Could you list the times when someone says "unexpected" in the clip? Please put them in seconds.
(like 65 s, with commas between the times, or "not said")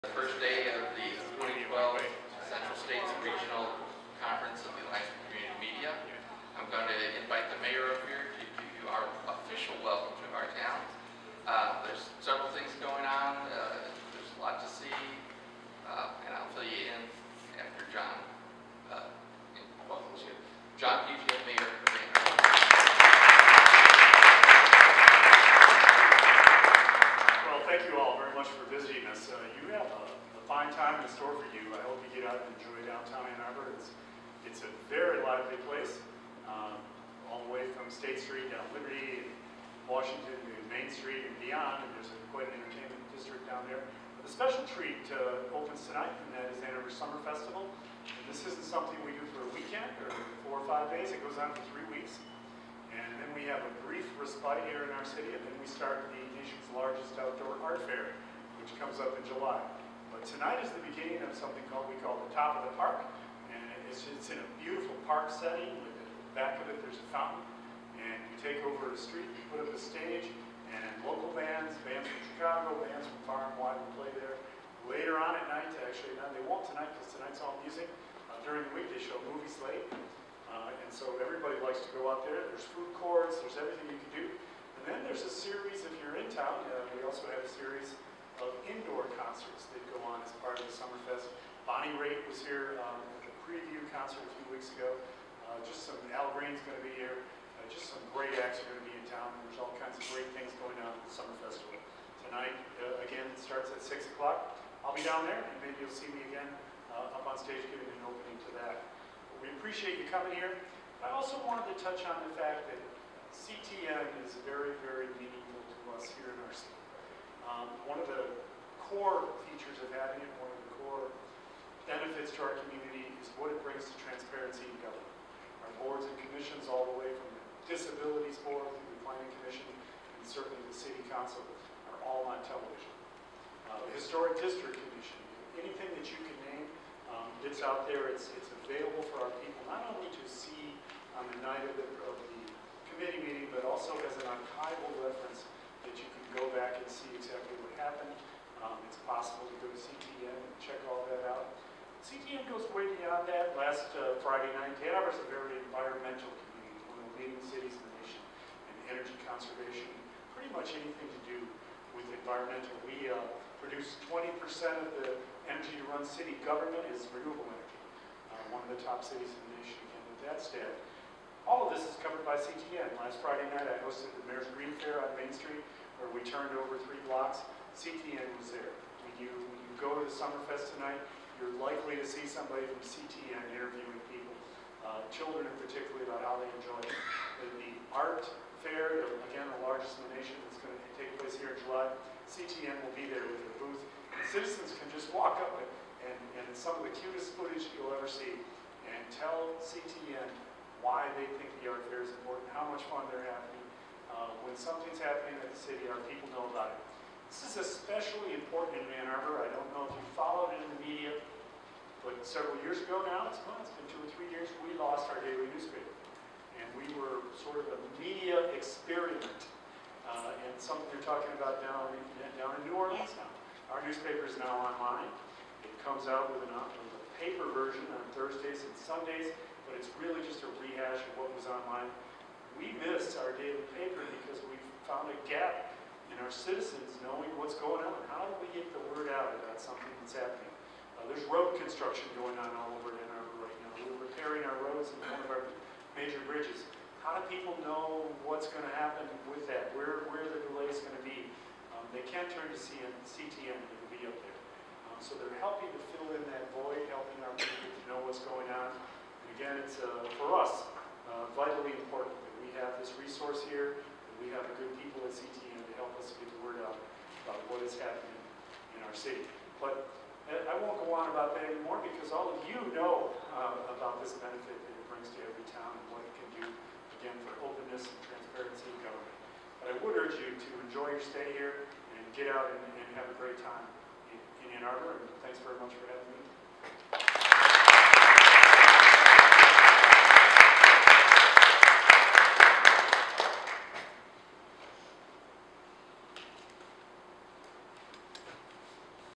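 not said.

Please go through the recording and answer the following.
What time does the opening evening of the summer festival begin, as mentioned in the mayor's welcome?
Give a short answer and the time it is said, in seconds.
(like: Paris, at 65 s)
6 o'clock, at 103 s.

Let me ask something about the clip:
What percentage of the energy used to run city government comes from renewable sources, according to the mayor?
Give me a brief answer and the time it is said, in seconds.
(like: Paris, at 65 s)
20%, at 164 s.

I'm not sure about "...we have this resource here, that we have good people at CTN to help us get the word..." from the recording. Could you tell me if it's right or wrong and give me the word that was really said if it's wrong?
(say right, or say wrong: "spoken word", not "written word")
right.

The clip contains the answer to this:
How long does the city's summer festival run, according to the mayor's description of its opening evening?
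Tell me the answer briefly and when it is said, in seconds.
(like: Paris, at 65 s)
3 weeks, at 51 s.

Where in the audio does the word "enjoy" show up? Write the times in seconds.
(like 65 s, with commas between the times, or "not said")
32 s, 186 s, 280 s.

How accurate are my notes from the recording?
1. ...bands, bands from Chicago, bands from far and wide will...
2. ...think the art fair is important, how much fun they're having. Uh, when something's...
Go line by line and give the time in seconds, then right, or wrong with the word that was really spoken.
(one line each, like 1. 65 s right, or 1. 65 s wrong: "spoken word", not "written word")
1. 71 s right
2. 201 s right.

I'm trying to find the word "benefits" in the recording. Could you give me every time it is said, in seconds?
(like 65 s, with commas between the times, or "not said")
121 s, 274 s.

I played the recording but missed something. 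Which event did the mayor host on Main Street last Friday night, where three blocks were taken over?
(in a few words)
Mayor's Green Fair.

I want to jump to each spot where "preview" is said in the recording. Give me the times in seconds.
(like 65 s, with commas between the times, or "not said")
93 s.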